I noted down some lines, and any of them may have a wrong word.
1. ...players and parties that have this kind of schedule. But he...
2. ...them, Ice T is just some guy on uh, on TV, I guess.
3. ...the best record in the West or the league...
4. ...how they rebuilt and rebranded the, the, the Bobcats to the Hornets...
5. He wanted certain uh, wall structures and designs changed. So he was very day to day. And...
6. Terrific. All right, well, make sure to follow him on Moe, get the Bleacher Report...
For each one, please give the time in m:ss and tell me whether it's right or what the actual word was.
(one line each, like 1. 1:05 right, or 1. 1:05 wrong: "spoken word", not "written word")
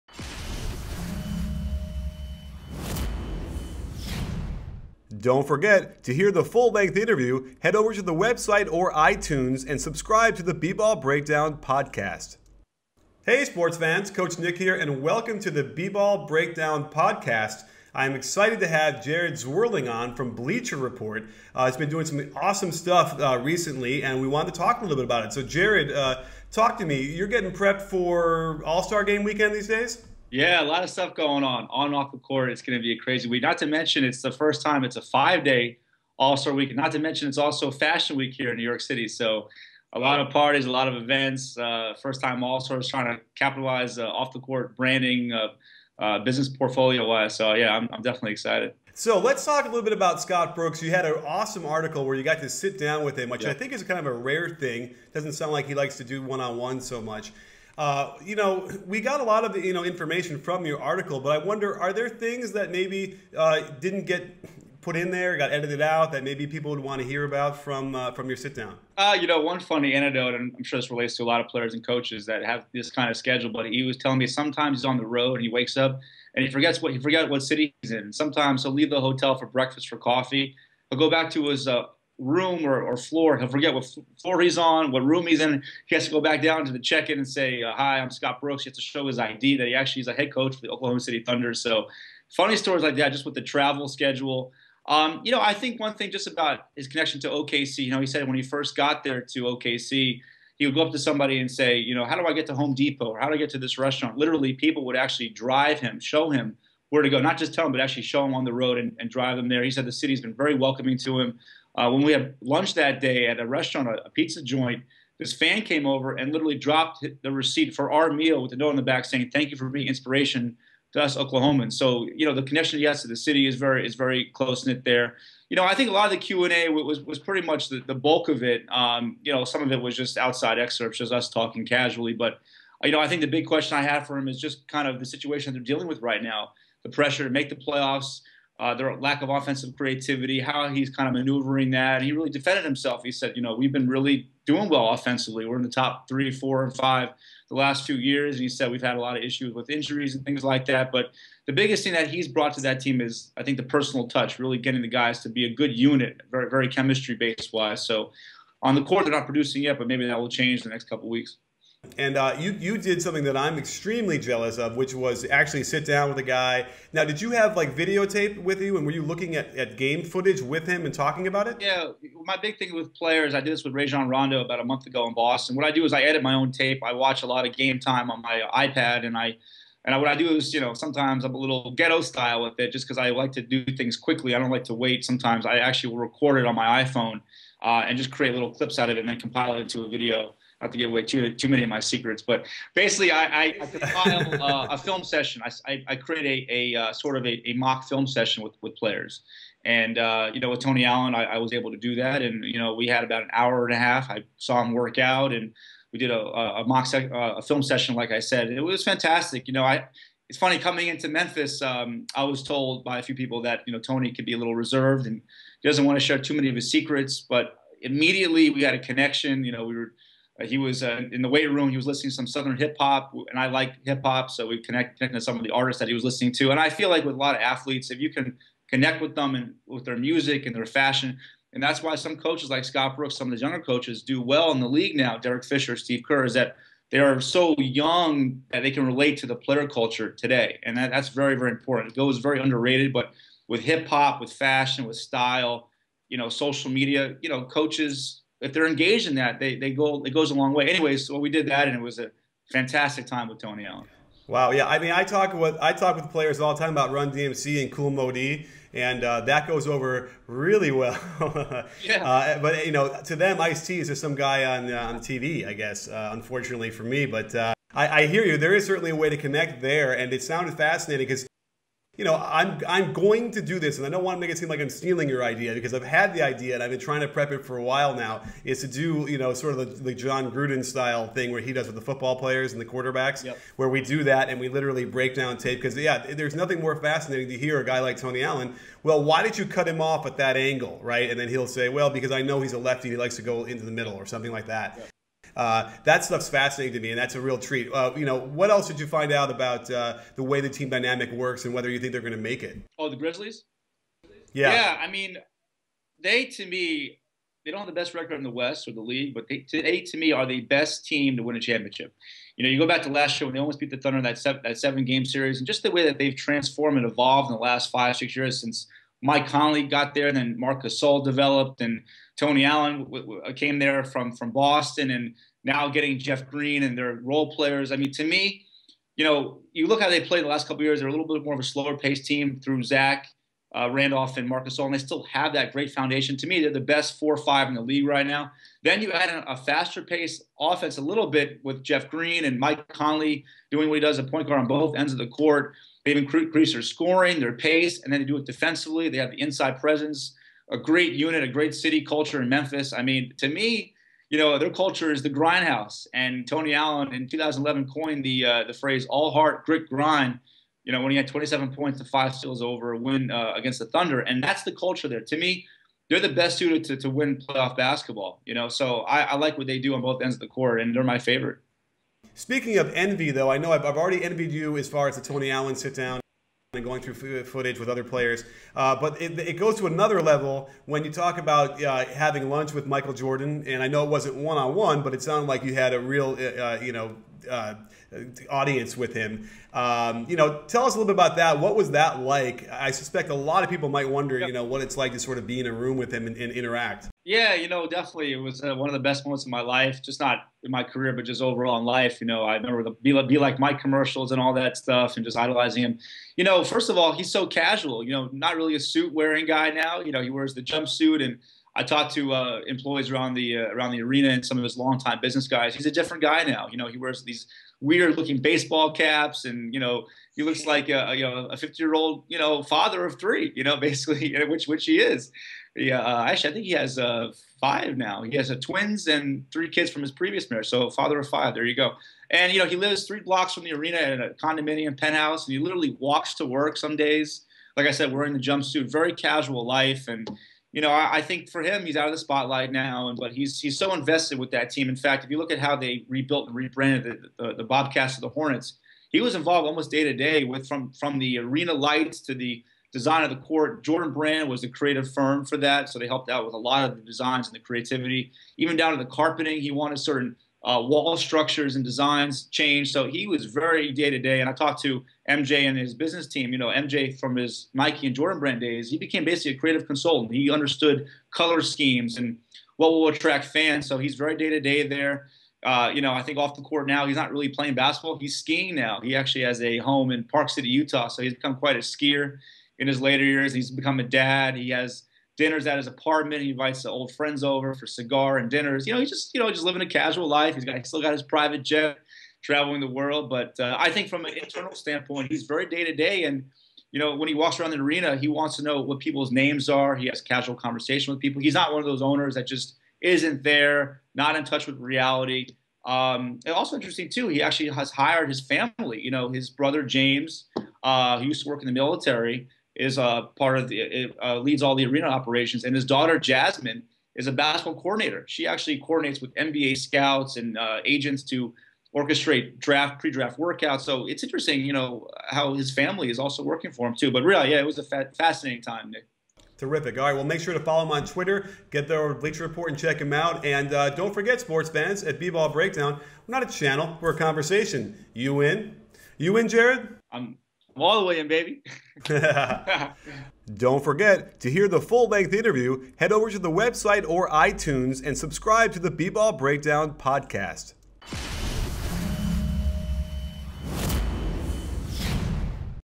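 1. 1:11 wrong: "coaches", not "parties"
2. 4:23 right
3. 5:07 right
4. 7:25 right
5. 7:39 right
6. 8:49 wrong: "Twitter", not "Moe".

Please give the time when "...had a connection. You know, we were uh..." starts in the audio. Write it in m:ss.
3:38.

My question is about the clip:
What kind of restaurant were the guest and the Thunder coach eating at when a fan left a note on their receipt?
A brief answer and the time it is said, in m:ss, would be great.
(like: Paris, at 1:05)
A pizza joint, at 1:54.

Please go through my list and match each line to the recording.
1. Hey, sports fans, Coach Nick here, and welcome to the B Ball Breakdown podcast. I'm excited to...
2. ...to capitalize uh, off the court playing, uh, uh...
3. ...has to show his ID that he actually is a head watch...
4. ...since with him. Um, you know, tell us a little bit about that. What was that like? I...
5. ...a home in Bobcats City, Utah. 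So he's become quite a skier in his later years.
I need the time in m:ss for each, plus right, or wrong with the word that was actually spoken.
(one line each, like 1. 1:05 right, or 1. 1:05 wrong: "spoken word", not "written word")
1. 0:13 right
2. 0:43 wrong: "branding", not "playing"
3. 1:28 wrong: "coach", not "watch"
4. 6:28 wrong: "audience", not "since"
5. 7:59 wrong: "Park", not "Bobcats".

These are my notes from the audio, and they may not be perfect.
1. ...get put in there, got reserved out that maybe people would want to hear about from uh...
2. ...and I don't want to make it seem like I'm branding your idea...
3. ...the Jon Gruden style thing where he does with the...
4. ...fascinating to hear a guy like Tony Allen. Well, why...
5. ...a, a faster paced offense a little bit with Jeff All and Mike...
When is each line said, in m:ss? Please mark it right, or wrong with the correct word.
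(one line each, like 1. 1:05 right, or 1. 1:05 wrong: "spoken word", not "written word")
1. 1:04 wrong: "edited", not "reserved"
2. 4:33 wrong: "stealing", not "branding"
3. 4:39 right
4. 4:46 right
5. 5:39 wrong: "Green", not "All".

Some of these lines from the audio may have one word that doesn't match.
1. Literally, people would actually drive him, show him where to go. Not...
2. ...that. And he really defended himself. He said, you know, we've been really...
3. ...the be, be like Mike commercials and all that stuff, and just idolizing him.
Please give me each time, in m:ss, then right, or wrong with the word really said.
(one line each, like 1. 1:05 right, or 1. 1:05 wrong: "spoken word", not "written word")
1. 1:44 right
2. 2:21 right
3. 6:42 right.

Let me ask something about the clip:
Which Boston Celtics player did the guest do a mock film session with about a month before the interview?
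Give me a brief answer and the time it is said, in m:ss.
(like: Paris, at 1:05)
Rajon Rondo, at 2:53.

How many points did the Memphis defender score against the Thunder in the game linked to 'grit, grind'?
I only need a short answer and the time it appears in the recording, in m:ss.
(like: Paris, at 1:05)
27, at 6:01.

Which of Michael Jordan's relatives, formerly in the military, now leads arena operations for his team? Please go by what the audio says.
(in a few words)
James.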